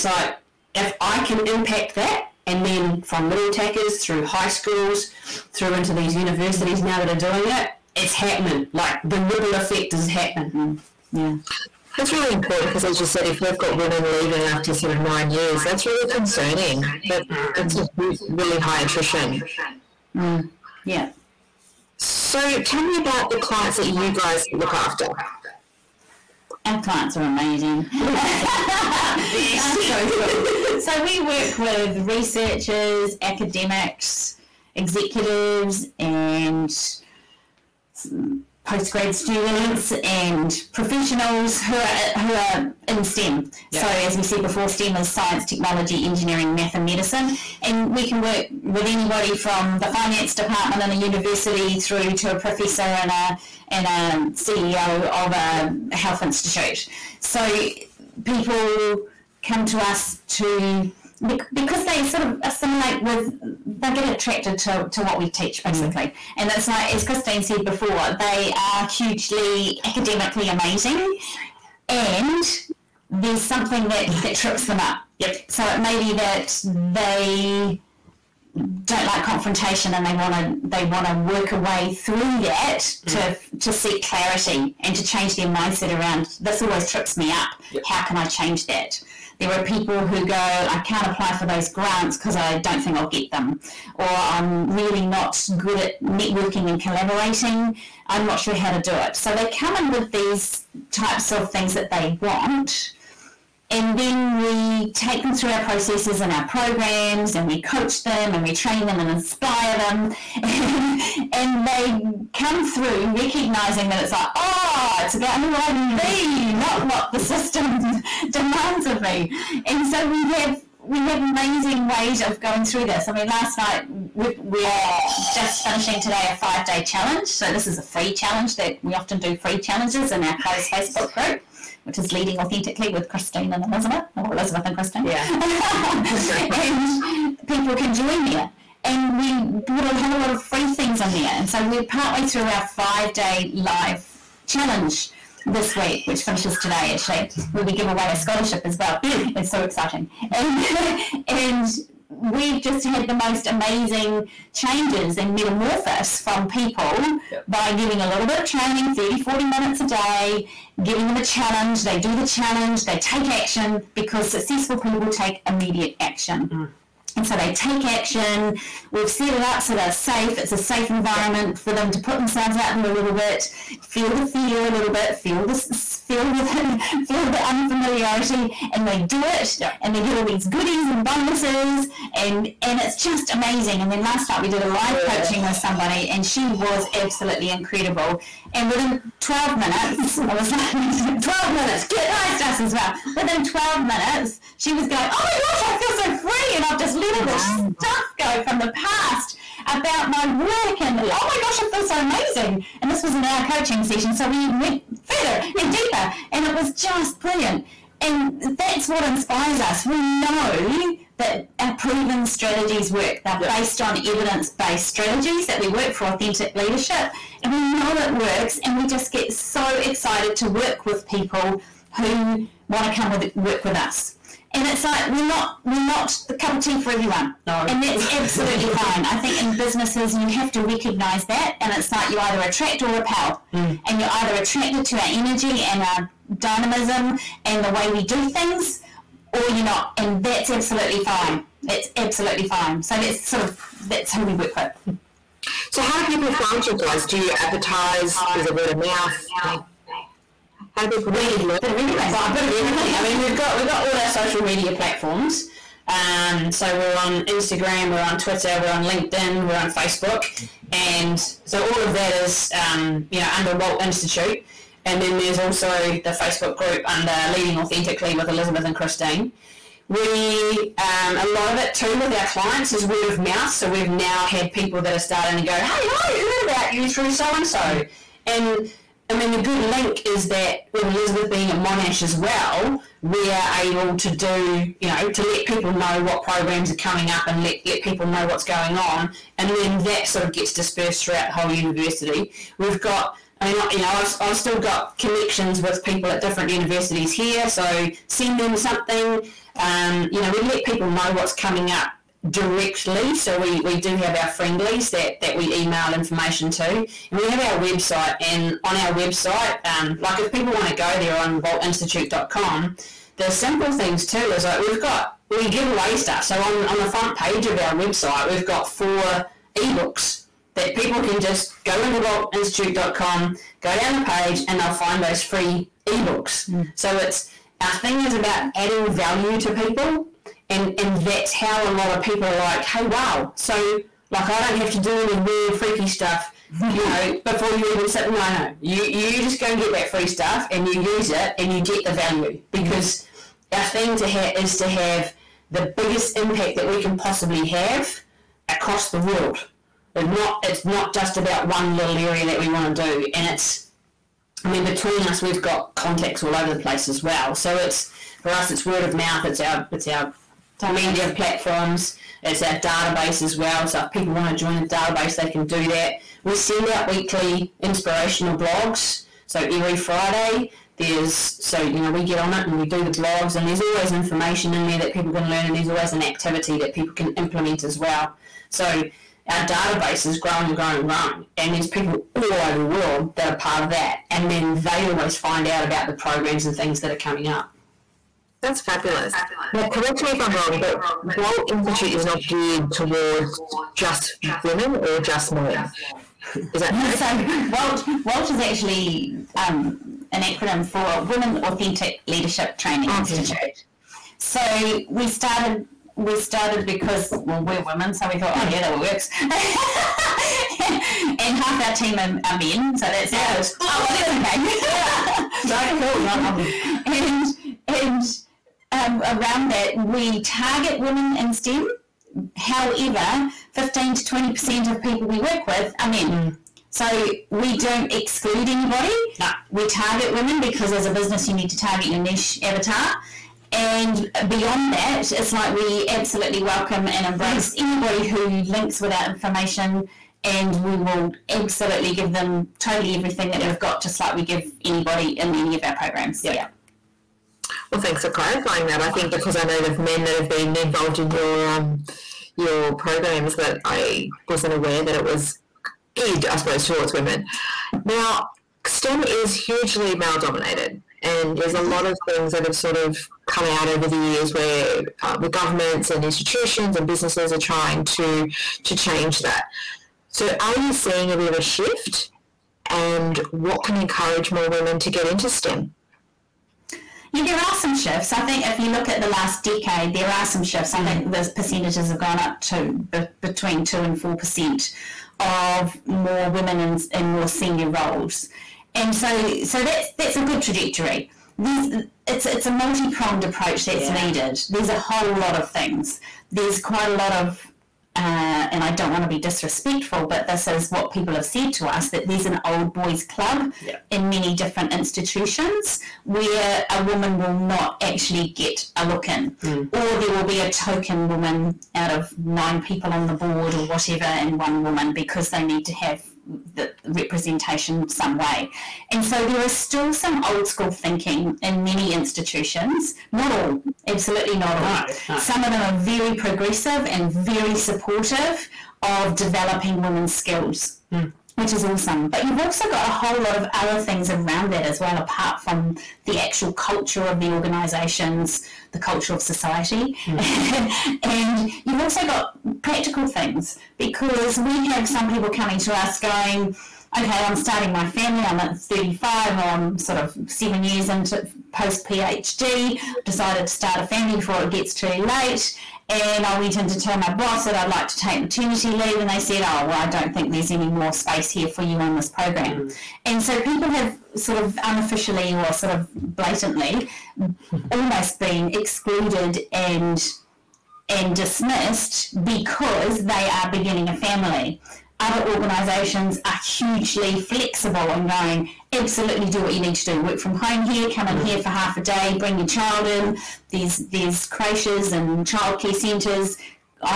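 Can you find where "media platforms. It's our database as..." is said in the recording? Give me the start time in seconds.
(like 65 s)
360 s.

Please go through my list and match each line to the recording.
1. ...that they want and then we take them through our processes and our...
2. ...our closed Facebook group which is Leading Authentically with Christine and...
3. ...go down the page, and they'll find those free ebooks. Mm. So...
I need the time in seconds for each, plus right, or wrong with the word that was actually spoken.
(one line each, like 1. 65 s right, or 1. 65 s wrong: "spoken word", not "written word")
1. 101 s right
2. 130 s right
3. 323 s right.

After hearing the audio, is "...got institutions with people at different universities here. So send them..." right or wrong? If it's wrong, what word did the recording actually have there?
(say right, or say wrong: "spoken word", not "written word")
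wrong: "connections", not "institutions".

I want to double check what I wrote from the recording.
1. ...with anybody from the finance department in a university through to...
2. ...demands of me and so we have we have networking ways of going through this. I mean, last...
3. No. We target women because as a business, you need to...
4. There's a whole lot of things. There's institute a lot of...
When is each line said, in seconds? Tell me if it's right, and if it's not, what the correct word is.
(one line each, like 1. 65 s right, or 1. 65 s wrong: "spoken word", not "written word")
1. 48 s right
2. 118 s wrong: "amazing", not "networking"
3. 429 s right
4. 494 s wrong: "quite", not "institute".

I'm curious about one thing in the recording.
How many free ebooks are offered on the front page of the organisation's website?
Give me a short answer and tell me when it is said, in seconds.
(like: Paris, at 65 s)
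4, at 318 s.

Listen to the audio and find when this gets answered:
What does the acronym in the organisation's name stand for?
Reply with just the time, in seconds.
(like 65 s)
401 s.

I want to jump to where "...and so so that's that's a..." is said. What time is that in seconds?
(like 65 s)
488 s.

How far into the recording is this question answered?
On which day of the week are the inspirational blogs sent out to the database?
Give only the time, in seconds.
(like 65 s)
369 s.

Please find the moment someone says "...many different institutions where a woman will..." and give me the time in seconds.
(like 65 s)
504 s.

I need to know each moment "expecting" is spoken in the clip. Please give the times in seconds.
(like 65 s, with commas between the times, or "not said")
not said.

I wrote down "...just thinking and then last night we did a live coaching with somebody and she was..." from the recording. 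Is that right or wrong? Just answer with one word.
wrong.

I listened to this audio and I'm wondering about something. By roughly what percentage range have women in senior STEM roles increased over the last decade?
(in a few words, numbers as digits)
2 to 4 percent.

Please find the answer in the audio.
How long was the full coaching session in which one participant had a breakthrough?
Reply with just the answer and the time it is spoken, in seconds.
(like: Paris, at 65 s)
An hour, at 203 s.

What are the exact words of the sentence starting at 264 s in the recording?
And then there's also the Facebook group under Leading Authentically with Elizabeth and Christine.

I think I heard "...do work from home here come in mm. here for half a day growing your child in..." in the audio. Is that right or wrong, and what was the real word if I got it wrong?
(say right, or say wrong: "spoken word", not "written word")
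wrong: "bring", not "growing".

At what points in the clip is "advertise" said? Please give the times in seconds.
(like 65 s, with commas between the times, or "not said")
247 s.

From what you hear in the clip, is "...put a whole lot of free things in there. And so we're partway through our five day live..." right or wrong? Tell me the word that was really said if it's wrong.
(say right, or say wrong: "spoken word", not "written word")
right.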